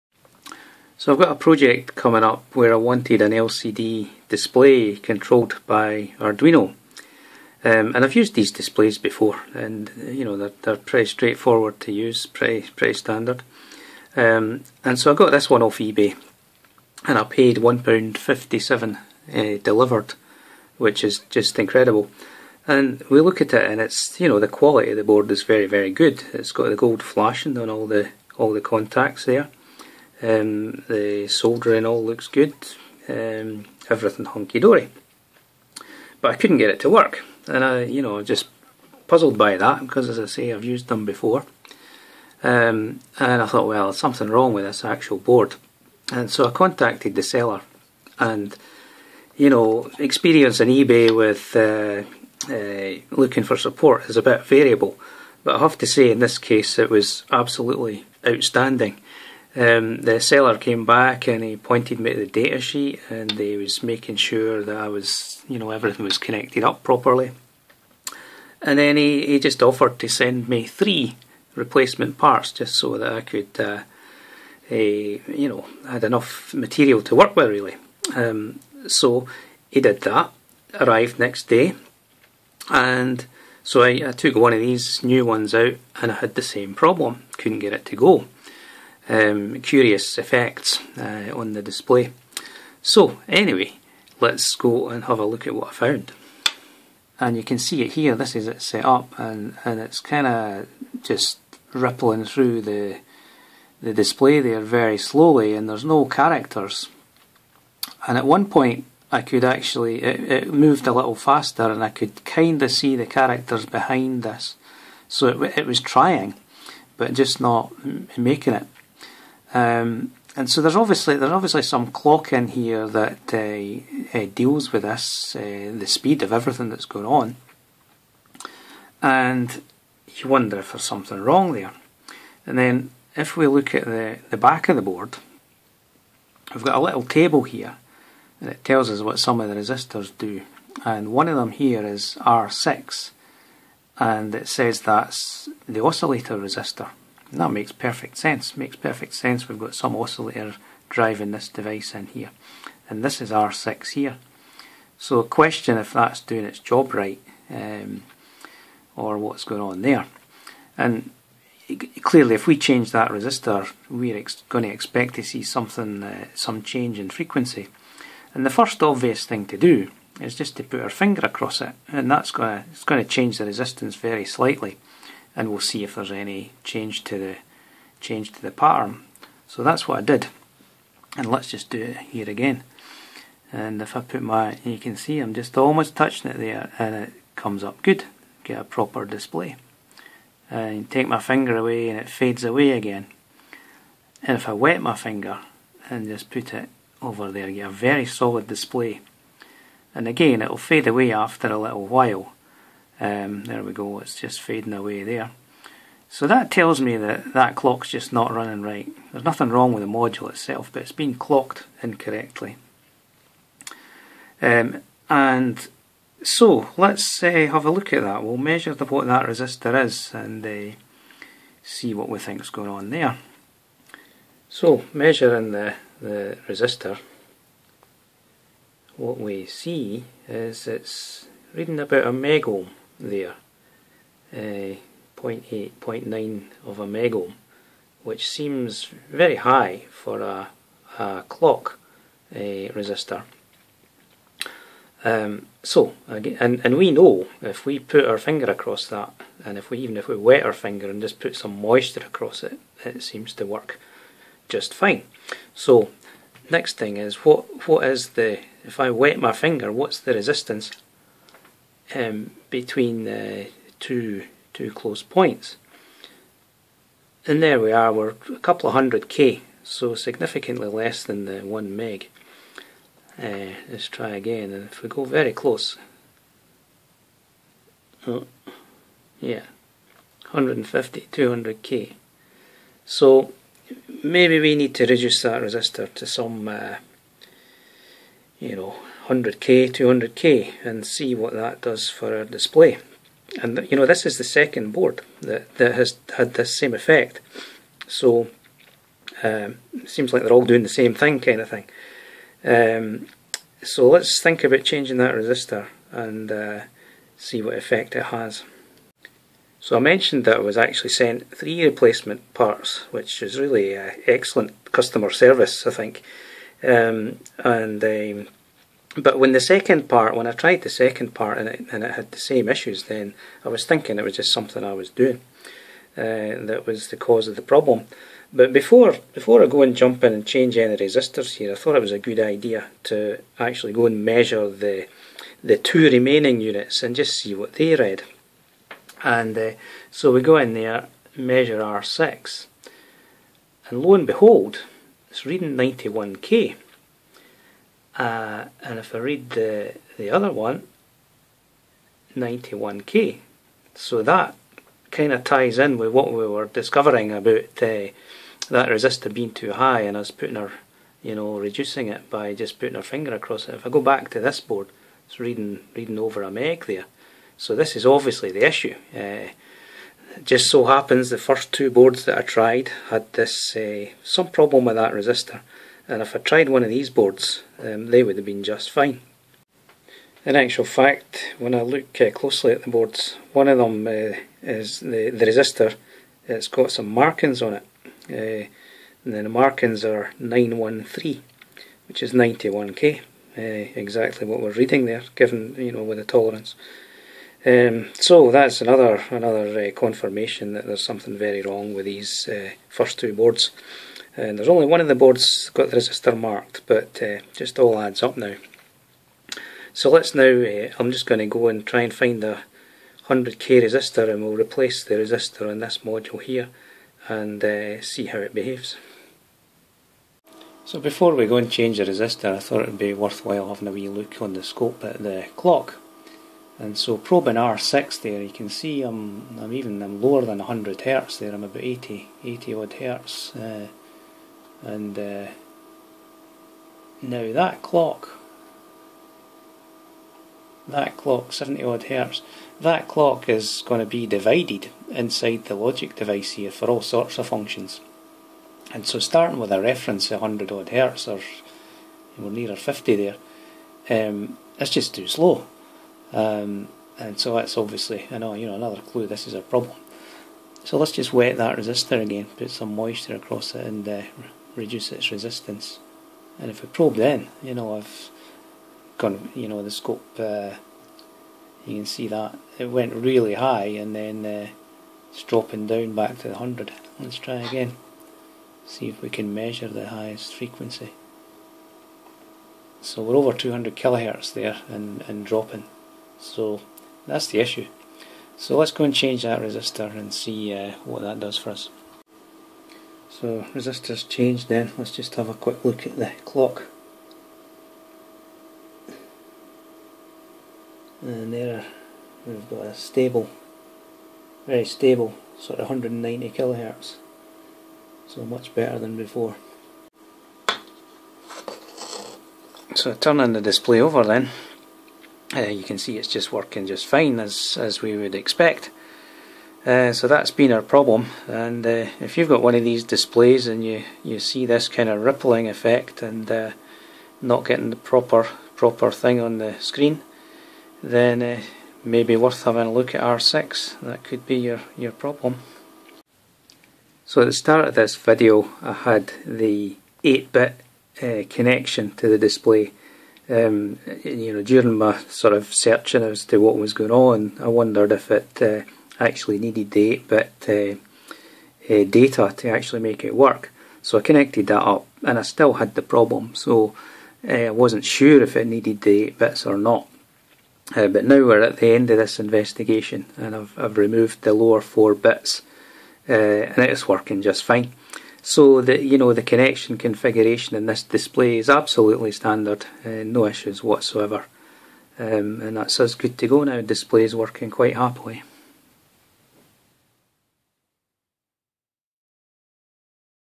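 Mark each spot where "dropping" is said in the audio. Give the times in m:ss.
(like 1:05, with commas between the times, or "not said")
7:55, 8:05.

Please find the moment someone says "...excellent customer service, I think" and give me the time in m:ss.
5:14.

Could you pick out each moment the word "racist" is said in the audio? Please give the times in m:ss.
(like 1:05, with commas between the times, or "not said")
not said.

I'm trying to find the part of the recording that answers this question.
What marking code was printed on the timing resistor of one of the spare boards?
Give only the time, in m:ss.
6:30.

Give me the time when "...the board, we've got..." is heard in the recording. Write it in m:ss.
2:14.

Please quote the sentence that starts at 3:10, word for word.
And take my finger away and it fades away again.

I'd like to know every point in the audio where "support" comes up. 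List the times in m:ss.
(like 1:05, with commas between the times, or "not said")
0:53.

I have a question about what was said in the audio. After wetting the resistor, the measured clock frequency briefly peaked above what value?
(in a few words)
200 kilohertz.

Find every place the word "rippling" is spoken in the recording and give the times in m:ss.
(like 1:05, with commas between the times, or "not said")
1:41, 8:45.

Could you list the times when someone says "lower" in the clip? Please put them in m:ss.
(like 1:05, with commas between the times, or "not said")
7:09, 9:24.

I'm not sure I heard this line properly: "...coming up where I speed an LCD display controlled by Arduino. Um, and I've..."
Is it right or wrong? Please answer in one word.
wrong.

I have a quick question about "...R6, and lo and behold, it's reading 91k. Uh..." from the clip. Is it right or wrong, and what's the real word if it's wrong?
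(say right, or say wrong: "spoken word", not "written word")
right.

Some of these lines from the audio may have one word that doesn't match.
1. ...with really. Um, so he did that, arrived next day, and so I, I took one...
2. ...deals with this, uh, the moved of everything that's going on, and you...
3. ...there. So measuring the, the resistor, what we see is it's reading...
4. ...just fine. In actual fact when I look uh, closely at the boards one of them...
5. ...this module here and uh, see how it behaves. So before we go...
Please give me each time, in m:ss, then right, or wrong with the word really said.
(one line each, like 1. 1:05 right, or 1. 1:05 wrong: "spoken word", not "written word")
1. 1:17 right
2. 2:04 wrong: "speed", not "moved"
3. 3:42 right
4. 6:18 right
5. 6:55 right.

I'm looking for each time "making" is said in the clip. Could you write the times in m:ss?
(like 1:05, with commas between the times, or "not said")
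1:03, 1:58.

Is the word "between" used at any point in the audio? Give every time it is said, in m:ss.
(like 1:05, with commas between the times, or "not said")
4:22.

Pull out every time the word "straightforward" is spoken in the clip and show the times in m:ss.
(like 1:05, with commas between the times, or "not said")
0:11.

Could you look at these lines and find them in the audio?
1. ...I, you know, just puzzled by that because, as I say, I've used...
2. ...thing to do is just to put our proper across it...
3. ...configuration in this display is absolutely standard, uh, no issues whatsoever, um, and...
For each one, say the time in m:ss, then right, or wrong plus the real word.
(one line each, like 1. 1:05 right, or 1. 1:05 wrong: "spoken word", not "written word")
1. 0:37 right
2. 2:49 wrong: "finger", not "proper"
3. 9:29 right.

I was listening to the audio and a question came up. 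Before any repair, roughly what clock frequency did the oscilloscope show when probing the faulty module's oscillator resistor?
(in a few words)
80 hertz.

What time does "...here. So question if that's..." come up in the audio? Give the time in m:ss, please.
2:33.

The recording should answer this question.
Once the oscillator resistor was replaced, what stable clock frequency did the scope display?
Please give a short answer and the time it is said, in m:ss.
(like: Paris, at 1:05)
190 kilohertz, at 8:25.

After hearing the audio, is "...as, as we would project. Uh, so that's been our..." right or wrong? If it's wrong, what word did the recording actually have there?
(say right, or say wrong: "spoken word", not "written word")
wrong: "expect", not "project".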